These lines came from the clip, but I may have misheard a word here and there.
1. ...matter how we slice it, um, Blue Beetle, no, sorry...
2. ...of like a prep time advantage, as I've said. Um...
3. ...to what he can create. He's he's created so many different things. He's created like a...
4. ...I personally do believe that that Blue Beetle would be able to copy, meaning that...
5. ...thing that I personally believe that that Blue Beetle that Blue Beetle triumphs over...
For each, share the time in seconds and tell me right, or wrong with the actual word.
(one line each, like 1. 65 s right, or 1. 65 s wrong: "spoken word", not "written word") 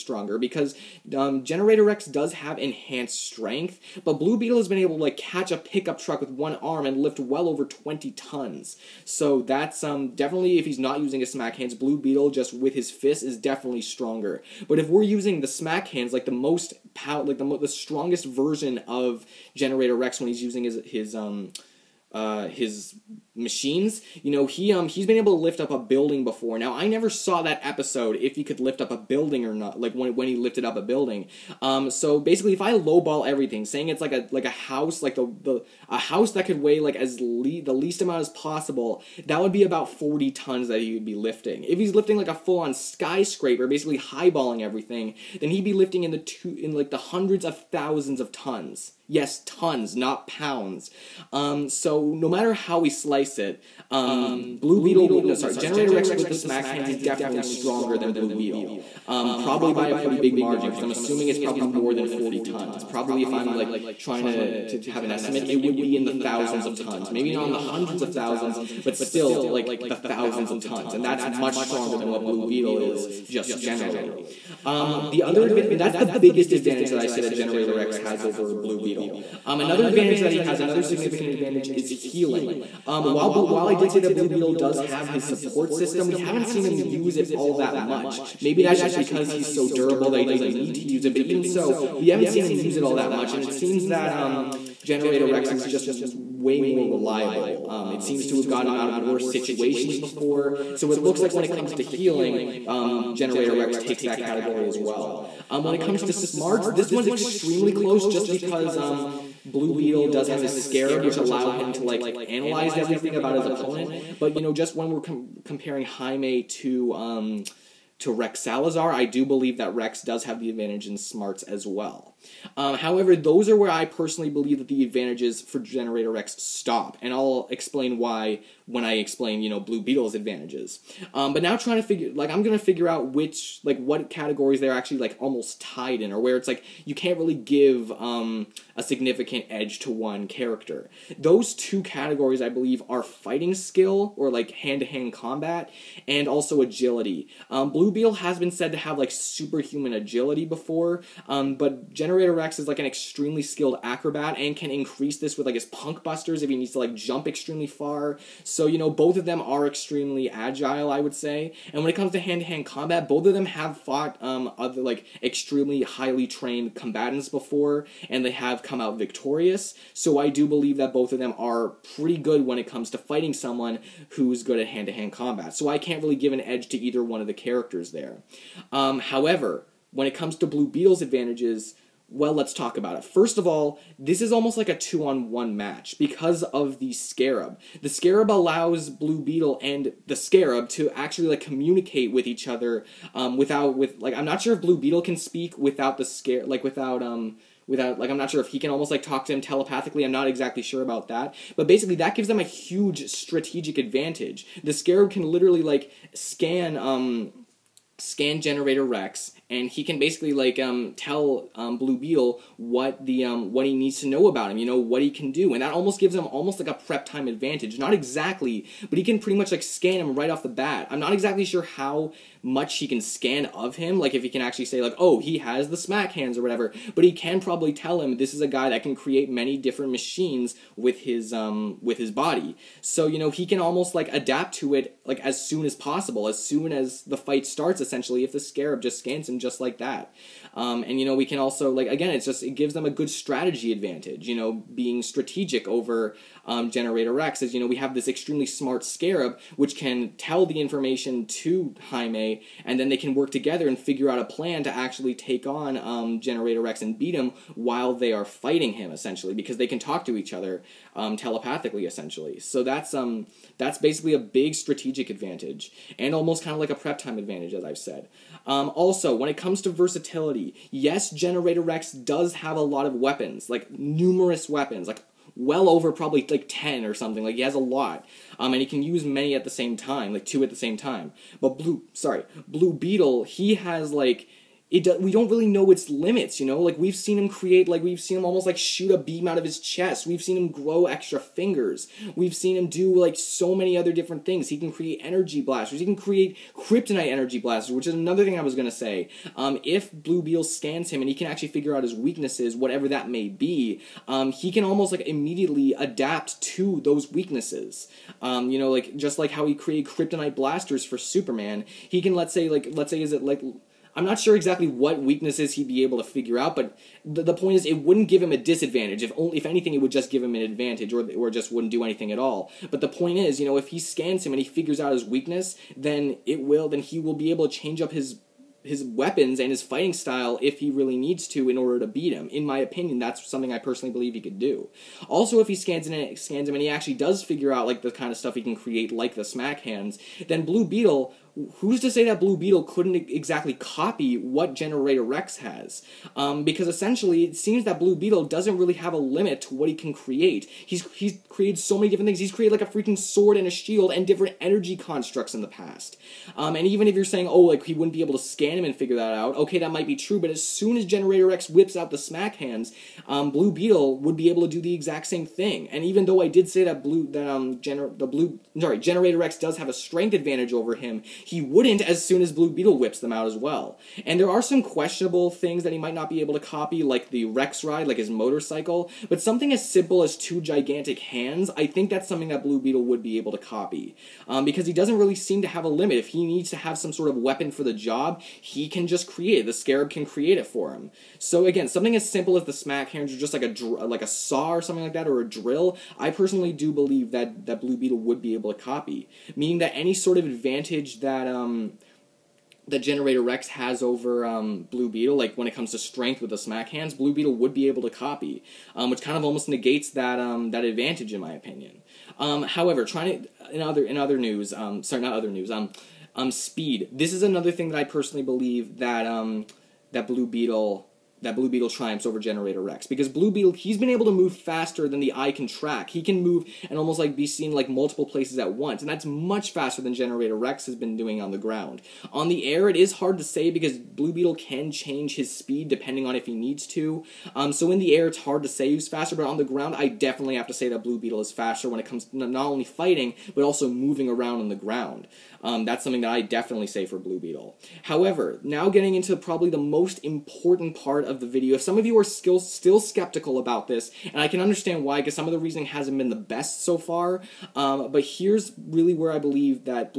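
1. 52 s right
2. 266 s right
3. 349 s right
4. 395 s right
5. 417 s right.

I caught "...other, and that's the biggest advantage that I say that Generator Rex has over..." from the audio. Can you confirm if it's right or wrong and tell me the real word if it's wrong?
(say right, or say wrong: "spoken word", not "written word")
right.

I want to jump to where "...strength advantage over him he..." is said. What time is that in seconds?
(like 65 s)
369 s.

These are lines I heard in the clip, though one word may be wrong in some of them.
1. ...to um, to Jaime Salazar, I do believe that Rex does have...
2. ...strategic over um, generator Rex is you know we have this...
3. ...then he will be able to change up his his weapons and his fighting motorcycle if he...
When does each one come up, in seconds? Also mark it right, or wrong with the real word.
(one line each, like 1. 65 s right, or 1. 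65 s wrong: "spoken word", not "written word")
1. 116 s wrong: "Rex", not "Jaime"
2. 245 s right
3. 326 s wrong: "style", not "motorcycle".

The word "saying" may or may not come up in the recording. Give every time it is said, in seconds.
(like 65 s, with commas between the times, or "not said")
33 s, 357 s.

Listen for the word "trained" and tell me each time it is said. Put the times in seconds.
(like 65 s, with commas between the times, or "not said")
166 s.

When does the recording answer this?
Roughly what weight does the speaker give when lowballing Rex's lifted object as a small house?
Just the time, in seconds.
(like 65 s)
39 s.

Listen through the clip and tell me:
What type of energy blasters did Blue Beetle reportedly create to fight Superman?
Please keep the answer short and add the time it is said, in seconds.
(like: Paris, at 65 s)
Kryptonite energy blasters, at 296 s.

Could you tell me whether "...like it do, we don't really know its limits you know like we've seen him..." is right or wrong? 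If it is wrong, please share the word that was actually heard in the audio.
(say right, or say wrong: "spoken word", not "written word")
right.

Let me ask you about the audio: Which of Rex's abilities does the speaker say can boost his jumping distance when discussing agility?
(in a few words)
Punk busters.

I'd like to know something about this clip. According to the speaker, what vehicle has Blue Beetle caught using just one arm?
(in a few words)
A pickup truck.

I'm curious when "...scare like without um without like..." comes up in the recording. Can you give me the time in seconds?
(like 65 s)
196 s.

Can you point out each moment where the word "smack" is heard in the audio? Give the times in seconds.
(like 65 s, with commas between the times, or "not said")
11 s, 15 s, 56 s, 225 s, 339 s, 361 s, 392 s, 406 s.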